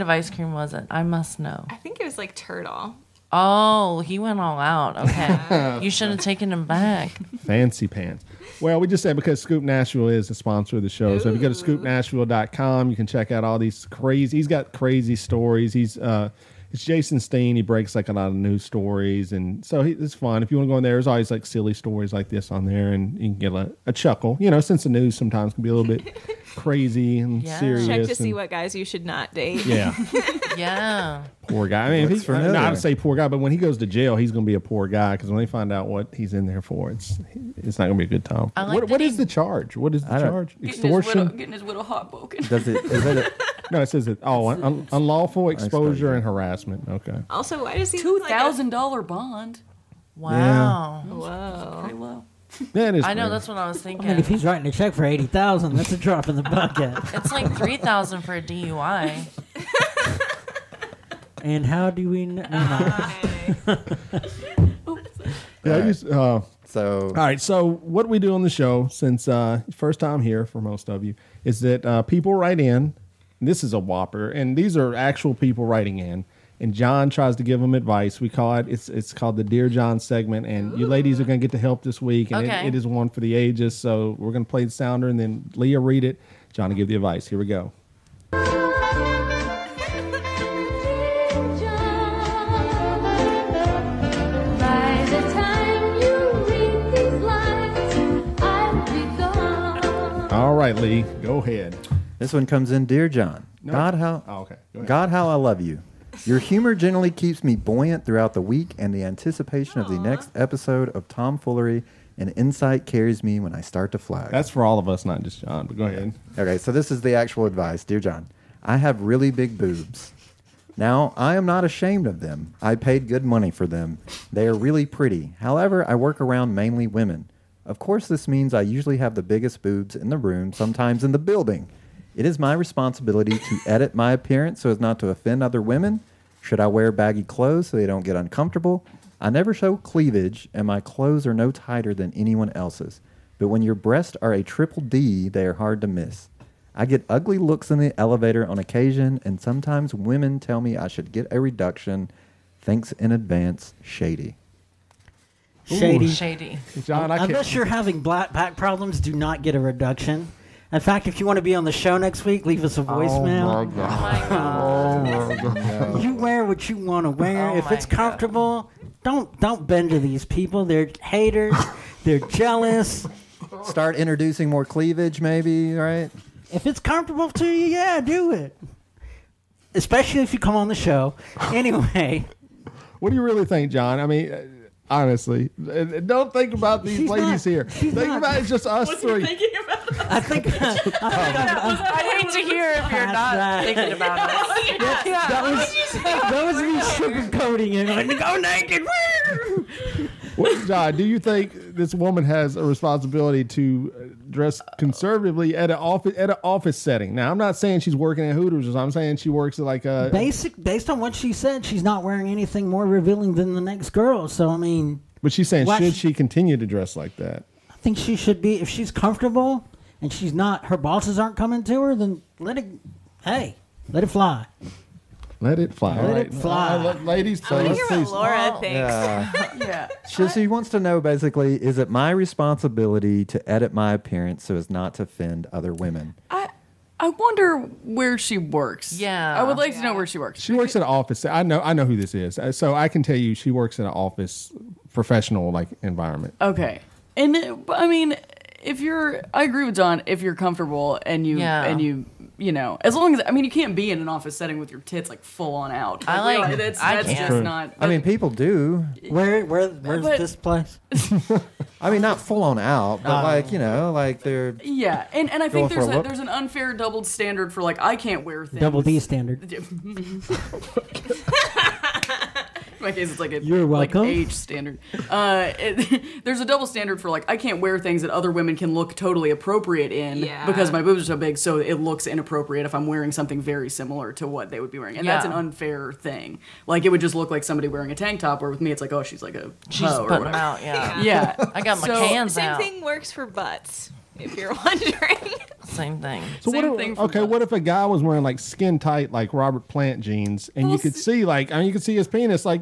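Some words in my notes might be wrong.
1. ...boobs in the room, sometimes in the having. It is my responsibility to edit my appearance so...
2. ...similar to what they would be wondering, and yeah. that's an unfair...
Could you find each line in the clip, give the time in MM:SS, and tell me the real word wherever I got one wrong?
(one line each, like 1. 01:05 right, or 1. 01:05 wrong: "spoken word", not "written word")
1. 02:09 wrong: "building", not "having"
2. 04:43 wrong: "wearing", not "wondering".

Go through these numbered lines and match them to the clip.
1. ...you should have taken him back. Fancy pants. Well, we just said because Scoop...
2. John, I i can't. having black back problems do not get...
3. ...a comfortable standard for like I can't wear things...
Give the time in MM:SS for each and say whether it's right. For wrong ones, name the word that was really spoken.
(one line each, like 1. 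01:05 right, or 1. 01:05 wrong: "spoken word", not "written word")
1. 00:05 right
2. 02:36 right
3. 04:36 wrong: "double", not "comfortable".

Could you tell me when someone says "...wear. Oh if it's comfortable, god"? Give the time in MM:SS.
02:47.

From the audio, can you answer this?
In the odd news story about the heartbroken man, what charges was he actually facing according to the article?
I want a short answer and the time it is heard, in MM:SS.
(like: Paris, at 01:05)
Unlawful exposure and harassment, at 00:44.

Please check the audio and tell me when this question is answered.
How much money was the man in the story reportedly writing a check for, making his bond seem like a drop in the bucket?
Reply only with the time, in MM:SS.
00:55.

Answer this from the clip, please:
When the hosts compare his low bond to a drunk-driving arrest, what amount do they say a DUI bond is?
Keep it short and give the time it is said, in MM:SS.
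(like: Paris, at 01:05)
3,000, at 00:57.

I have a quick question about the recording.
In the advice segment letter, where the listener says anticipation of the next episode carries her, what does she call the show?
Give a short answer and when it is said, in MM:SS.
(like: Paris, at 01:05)
Tomfoolery and Insight, at 01:51.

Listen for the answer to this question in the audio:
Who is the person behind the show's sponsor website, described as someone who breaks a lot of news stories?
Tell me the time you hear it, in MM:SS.
00:16.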